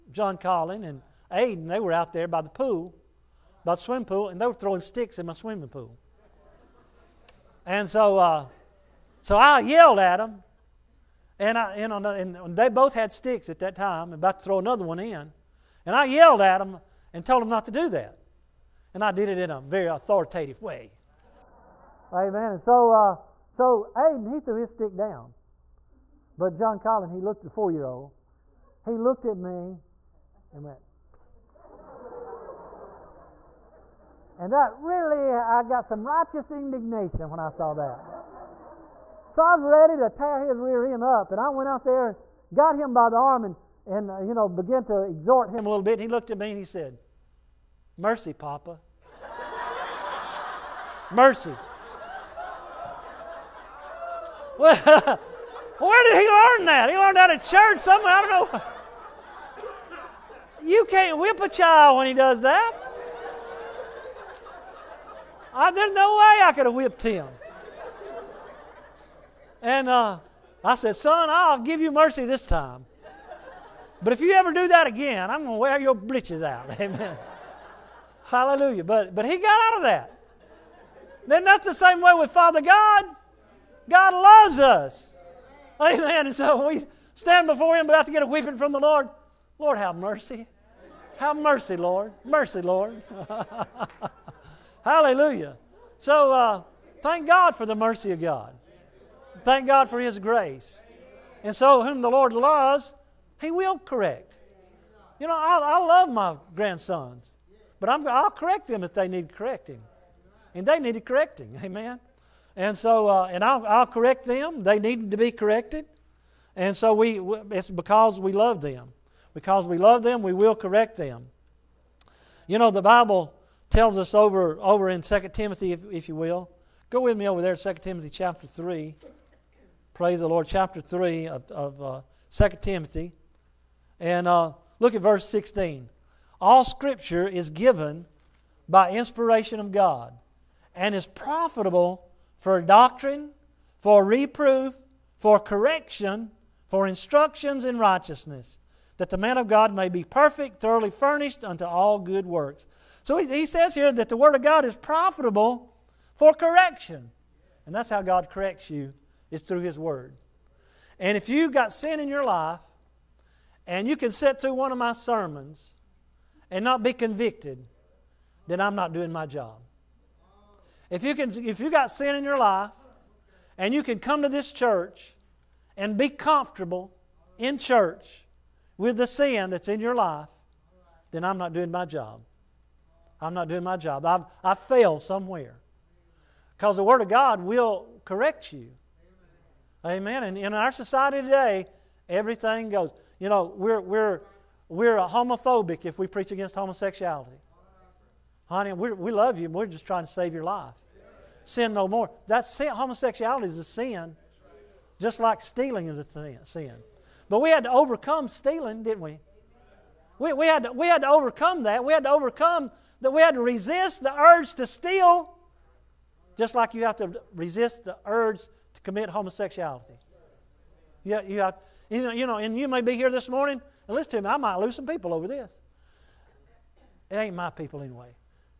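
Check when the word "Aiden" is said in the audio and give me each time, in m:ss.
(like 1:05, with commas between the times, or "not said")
0:01, 0:23.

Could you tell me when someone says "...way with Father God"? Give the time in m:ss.
1:22.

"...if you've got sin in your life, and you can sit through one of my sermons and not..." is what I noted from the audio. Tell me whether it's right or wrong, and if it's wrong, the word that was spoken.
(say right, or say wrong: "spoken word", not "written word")
right.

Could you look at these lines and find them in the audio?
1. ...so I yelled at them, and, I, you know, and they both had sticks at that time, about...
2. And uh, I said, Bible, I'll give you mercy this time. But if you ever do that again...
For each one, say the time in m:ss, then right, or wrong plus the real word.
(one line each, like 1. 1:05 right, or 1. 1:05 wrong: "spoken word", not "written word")
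1. 0:09 right
2. 1:09 wrong: "Son", not "Bible".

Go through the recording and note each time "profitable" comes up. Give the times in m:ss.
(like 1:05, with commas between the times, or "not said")
2:21, 2:34.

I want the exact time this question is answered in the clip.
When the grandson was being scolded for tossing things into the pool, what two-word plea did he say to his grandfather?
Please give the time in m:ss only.
0:47.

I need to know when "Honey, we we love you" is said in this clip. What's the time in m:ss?
3:18.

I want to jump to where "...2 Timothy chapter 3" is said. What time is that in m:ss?
2:07.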